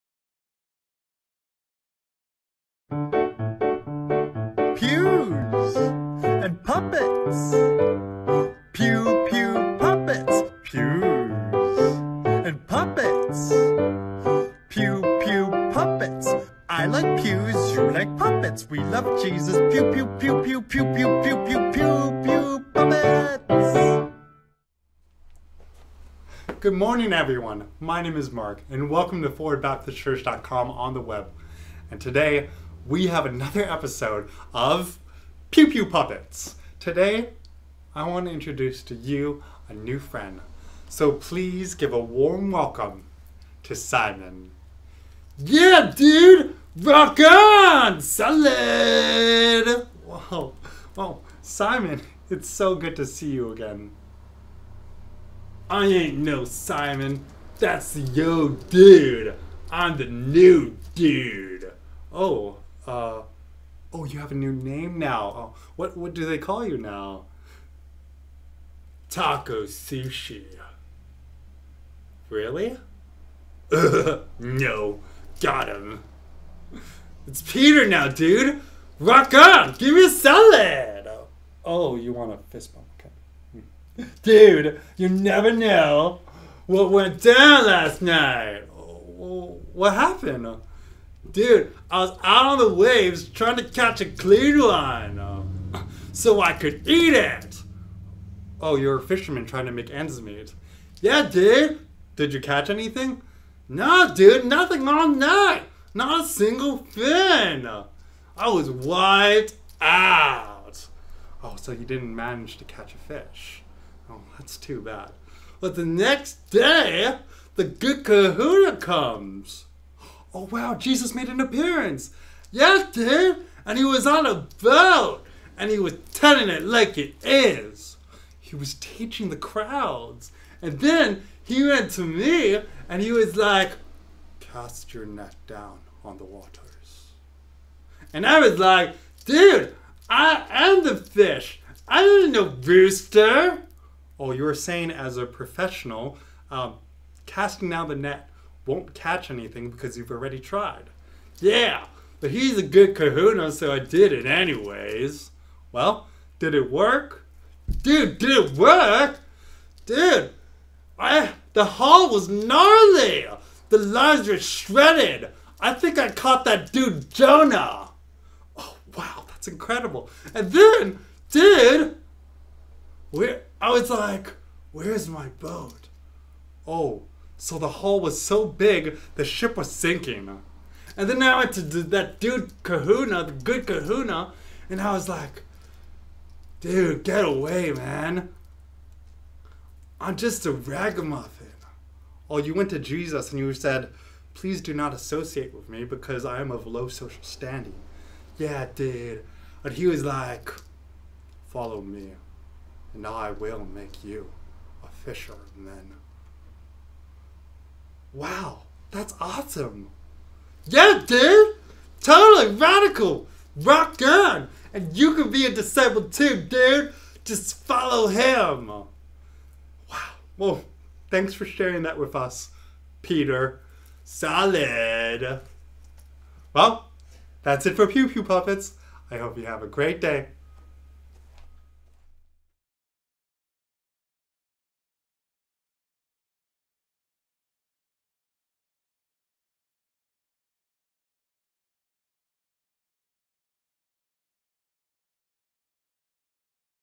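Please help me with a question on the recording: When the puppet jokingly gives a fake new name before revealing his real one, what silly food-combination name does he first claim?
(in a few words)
Taco sushi.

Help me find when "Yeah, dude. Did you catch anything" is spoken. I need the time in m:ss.
1:40.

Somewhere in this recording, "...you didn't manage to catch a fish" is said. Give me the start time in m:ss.
1:51.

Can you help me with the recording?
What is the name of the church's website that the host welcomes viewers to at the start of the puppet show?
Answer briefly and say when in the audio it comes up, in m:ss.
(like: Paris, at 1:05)
ForwardBaptistChurch.com, at 0:29.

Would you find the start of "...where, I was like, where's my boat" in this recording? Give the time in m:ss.
2:53.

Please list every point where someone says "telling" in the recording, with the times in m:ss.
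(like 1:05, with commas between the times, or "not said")
2:06.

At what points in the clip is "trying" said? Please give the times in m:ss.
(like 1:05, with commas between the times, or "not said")
1:33, 1:39.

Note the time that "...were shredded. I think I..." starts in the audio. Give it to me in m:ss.
2:44.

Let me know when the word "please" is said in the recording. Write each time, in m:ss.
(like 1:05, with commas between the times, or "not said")
0:41, 3:14.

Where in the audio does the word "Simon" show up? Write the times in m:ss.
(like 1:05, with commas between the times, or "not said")
0:43, 0:51, 0:56.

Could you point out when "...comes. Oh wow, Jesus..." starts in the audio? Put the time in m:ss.
1:58.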